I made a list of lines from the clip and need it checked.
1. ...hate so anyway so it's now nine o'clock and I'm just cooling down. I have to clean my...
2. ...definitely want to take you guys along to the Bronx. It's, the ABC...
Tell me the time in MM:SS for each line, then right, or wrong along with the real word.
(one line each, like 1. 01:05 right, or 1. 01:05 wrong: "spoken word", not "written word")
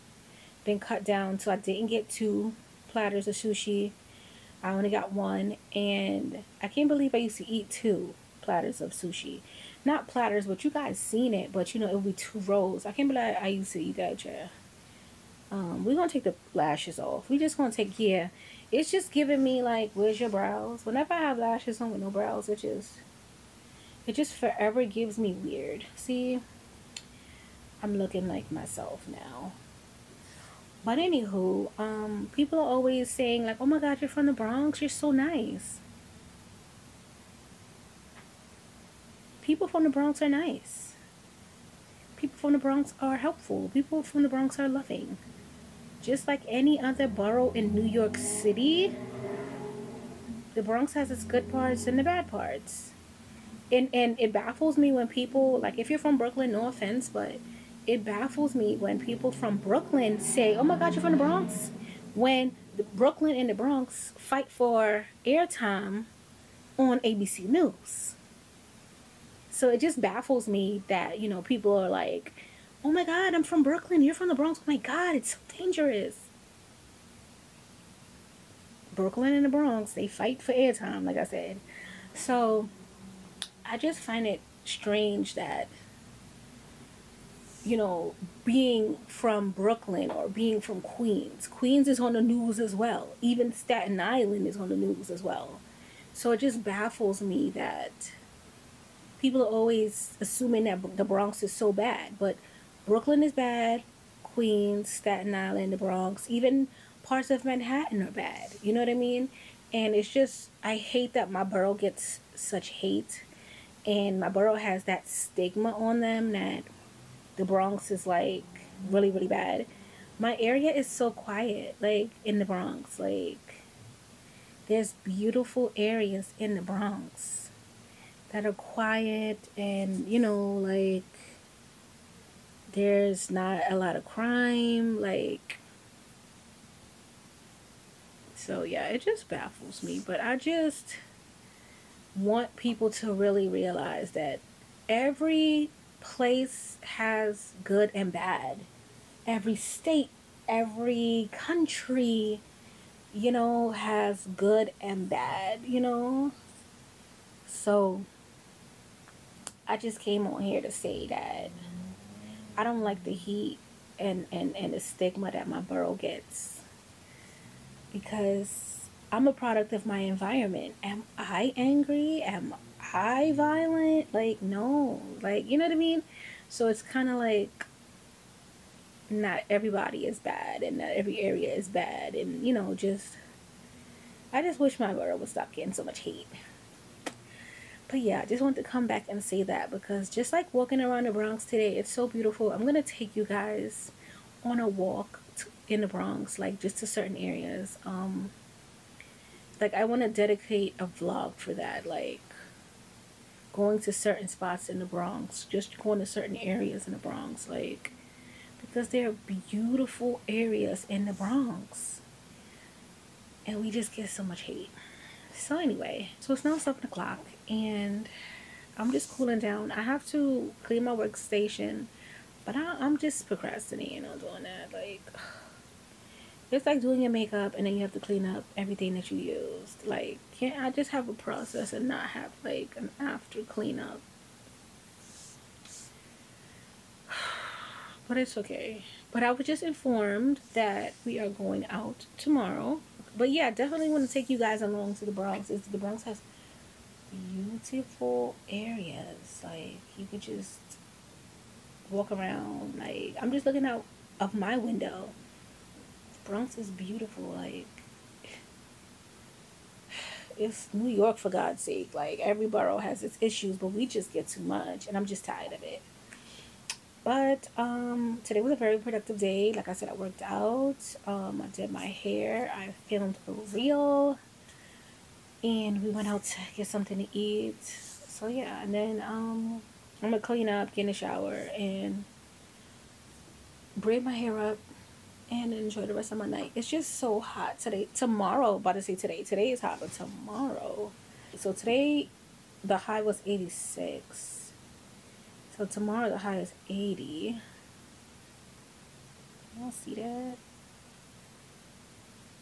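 1. 03:34 wrong: "seven", not "nine"
2. 04:03 wrong: "Bronx", not "ABC".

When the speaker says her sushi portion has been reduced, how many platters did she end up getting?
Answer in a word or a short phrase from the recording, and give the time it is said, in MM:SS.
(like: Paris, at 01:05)
1, at 00:04.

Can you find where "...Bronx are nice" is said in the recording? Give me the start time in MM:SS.
00:39.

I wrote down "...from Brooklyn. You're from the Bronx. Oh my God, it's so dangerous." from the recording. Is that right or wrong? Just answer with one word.
right.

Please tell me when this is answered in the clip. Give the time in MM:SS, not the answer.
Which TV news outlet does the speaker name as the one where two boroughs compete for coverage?
01:07.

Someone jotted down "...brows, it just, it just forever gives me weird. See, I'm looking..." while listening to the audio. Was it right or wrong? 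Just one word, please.
right.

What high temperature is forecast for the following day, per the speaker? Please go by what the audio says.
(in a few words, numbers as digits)
80.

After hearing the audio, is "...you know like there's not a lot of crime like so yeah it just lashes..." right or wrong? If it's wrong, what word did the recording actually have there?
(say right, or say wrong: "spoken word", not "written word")
wrong: "baffles", not "lashes".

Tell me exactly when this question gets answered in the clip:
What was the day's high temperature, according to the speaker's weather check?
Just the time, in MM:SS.
04:53.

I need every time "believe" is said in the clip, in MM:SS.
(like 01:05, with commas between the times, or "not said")
00:06, 00:13.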